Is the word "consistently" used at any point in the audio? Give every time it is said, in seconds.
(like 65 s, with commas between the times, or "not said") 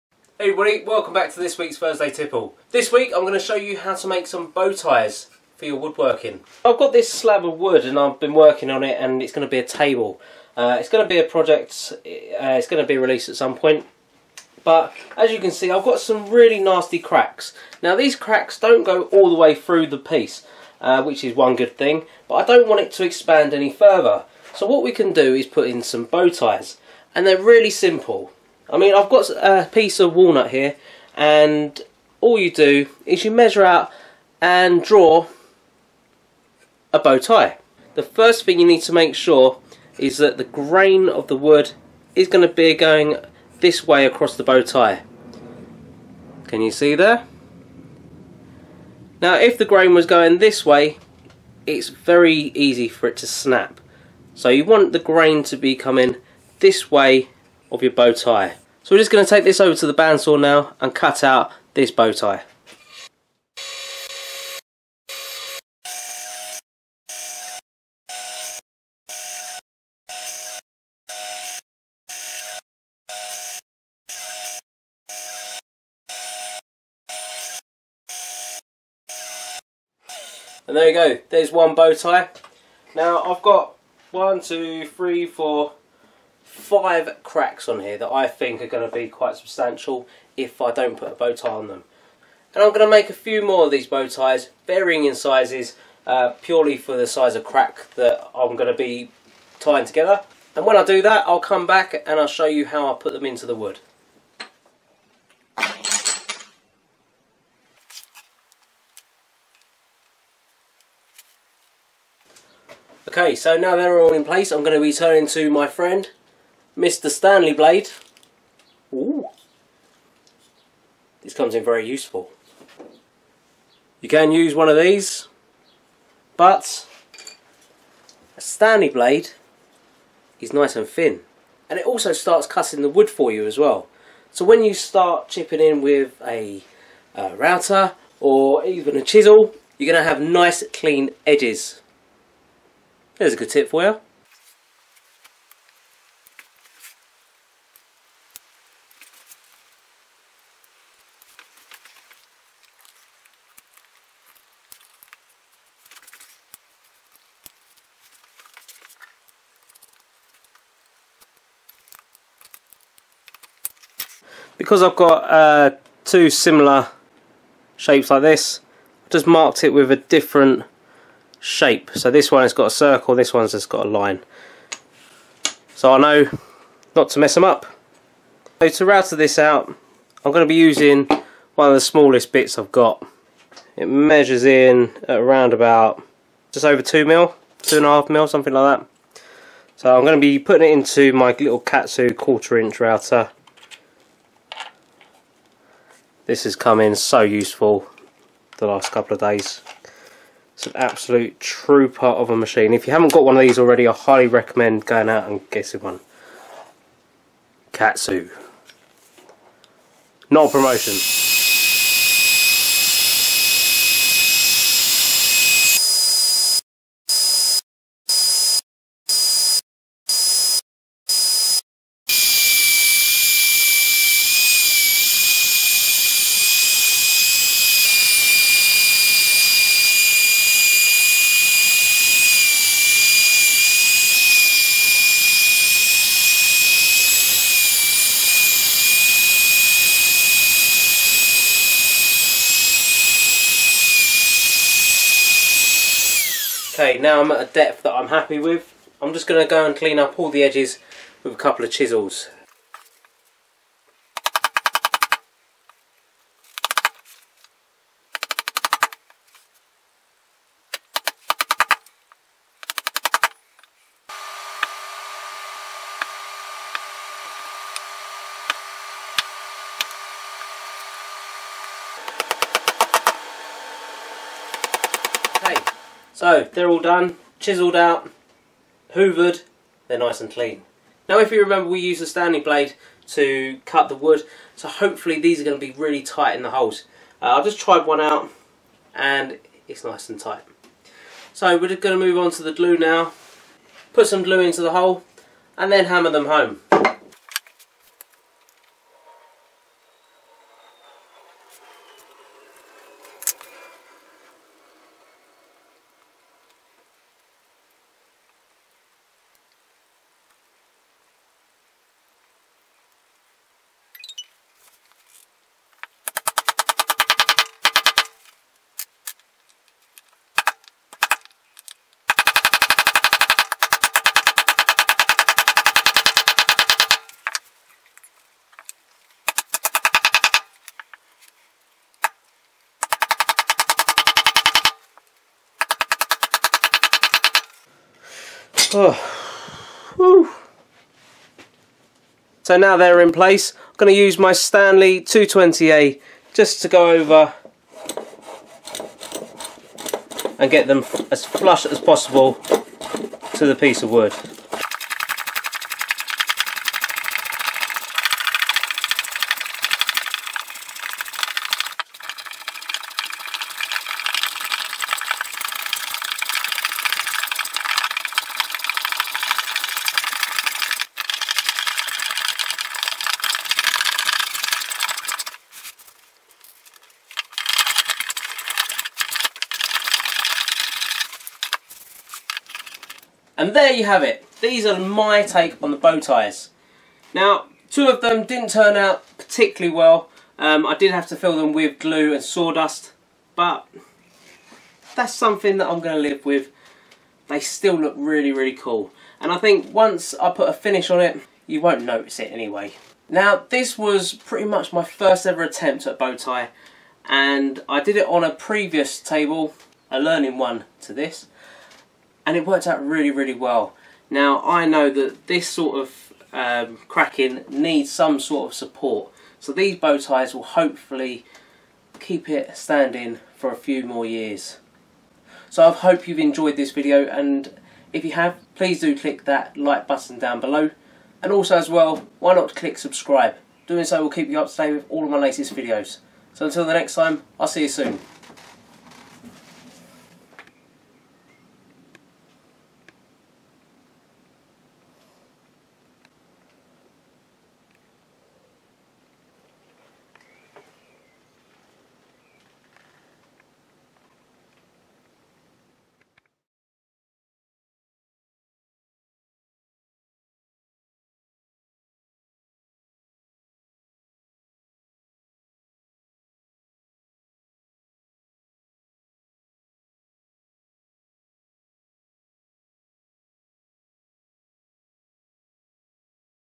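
not said.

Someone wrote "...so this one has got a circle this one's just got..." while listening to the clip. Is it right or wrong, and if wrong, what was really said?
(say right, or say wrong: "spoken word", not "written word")
right.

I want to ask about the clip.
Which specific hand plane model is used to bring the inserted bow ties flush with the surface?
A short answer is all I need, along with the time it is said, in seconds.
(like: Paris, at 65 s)
Stanley 220A, at 344 s.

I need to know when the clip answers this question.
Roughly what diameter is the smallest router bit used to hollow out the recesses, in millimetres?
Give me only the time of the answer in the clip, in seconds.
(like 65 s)
187 s.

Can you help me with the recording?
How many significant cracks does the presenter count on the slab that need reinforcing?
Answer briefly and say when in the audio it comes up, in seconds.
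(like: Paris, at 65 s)
5, at 86 s.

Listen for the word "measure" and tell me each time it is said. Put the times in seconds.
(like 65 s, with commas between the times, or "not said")
33 s, 183 s.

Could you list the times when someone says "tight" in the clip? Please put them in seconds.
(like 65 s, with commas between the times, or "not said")
286 s, 290 s.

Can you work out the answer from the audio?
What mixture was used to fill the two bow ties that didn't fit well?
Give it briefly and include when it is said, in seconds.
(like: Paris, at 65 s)
Glue and sawdust, at 391 s.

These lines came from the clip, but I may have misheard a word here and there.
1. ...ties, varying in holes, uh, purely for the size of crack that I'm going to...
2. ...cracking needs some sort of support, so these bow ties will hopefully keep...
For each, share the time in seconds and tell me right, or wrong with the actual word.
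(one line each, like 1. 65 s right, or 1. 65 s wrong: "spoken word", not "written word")
1. 94 s wrong: "sizes", not "holes"
2. 416 s right.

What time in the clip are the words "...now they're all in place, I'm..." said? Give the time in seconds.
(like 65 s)
113 s.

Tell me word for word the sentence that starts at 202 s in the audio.
If you haven't got one of these already, I highly recommend going out and getting one.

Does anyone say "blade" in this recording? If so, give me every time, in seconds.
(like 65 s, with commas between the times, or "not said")
117 s, 128 s, 282 s.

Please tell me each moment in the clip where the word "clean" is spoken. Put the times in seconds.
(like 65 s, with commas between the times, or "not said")
140 s, 249 s, 280 s.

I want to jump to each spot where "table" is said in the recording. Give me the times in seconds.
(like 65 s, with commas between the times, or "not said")
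9 s, 408 s.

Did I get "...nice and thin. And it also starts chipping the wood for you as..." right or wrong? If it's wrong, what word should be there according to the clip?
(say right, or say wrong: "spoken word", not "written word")
wrong: "cutting", not "chipping".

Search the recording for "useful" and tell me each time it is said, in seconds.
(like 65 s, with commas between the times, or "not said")
121 s, 197 s.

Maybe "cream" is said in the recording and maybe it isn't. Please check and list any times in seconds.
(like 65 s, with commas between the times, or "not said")
not said.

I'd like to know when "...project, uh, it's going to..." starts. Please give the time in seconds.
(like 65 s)
11 s.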